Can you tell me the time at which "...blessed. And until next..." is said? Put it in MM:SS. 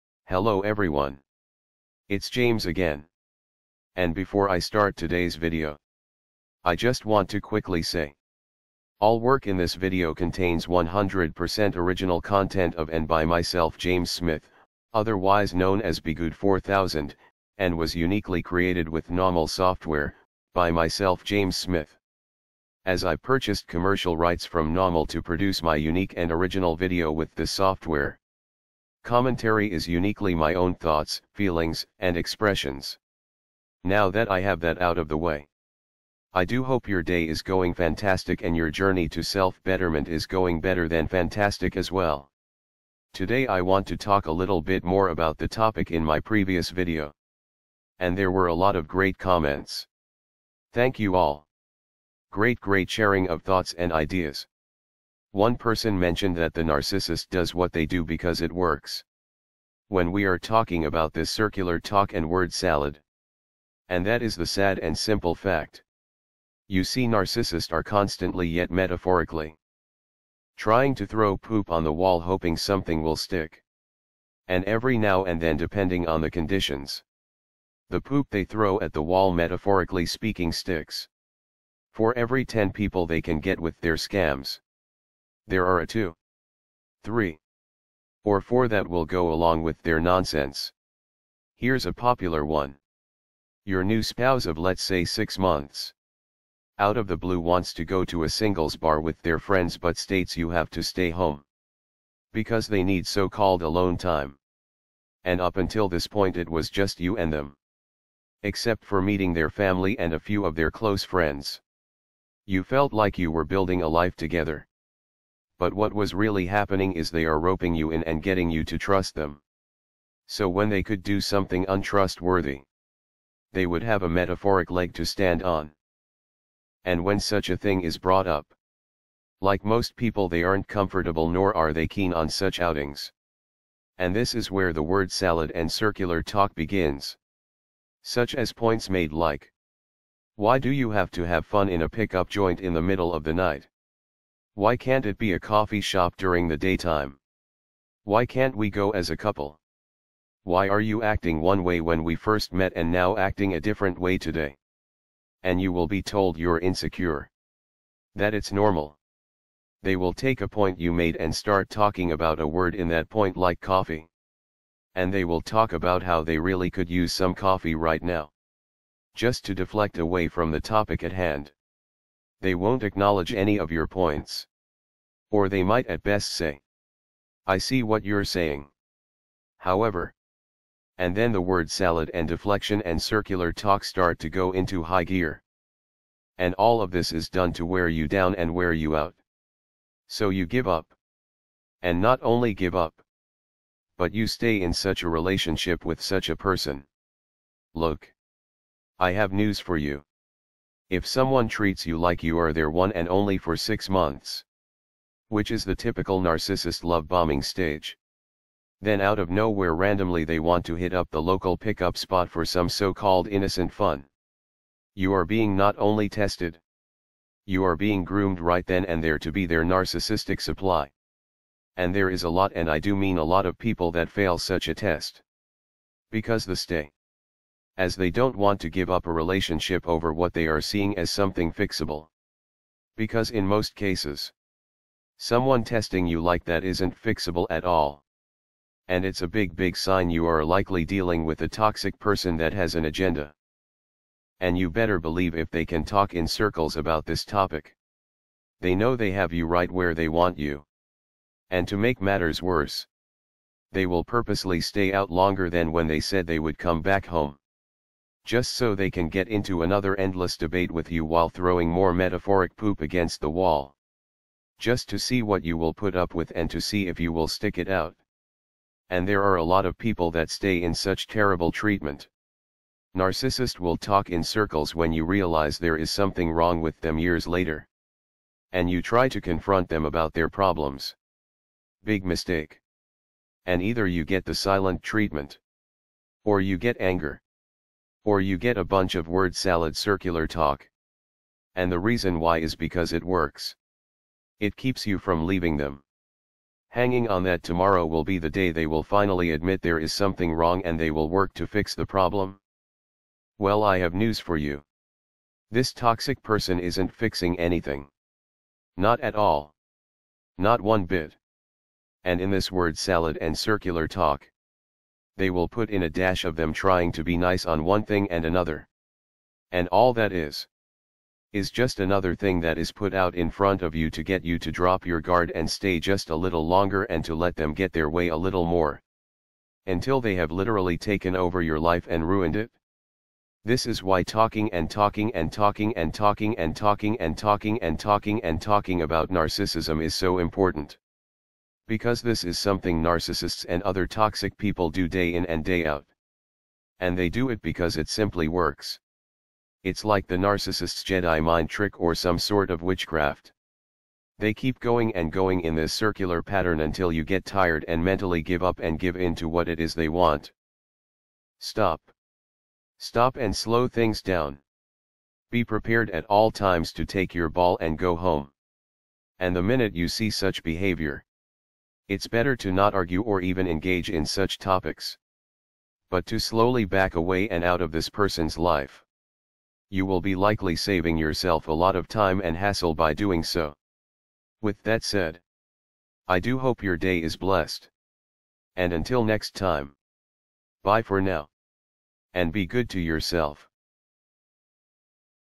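06:27.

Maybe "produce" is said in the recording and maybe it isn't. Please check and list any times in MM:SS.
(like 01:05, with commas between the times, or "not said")
00:25.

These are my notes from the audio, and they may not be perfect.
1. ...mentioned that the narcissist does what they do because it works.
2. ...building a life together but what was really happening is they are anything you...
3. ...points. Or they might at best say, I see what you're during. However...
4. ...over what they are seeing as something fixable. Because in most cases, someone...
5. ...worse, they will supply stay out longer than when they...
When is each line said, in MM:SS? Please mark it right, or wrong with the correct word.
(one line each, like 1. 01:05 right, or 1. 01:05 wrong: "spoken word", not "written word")
1. 00:55 right
2. 01:53 wrong: "roping", not "anything"
3. 02:53 wrong: "saying", not "during"
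4. 03:49 right
5. 04:12 wrong: "purposely", not "supply".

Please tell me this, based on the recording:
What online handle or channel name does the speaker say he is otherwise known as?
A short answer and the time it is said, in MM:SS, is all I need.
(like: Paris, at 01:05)
begood 4000, at 00:15.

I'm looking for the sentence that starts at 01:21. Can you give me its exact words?
For every 10 people they can get with their scams.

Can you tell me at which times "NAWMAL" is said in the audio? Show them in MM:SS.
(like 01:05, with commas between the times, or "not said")
00:19, 00:24.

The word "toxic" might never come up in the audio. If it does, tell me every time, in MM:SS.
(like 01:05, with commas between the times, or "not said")
04:01, 05:05, 05:43.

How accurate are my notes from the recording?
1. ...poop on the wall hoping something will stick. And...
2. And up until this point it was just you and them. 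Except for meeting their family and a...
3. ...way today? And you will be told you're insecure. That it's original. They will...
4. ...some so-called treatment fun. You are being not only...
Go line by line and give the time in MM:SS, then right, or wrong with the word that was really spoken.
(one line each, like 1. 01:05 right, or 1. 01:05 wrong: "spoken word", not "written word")
1. 01:11 right
2. 01:45 right
3. 02:33 wrong: "normal", not "original"
4. 03:32 wrong: "innocent", not "treatment".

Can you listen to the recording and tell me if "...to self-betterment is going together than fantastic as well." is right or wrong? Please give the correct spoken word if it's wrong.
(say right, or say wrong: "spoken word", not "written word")
wrong: "better", not "together".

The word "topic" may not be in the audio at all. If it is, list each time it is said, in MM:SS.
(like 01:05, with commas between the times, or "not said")
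00:45, 02:50, 04:07, 06:14.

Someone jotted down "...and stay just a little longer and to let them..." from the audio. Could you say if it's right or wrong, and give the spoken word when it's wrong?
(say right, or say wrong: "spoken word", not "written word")
right.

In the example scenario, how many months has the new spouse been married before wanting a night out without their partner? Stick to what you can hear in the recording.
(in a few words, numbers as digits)
6.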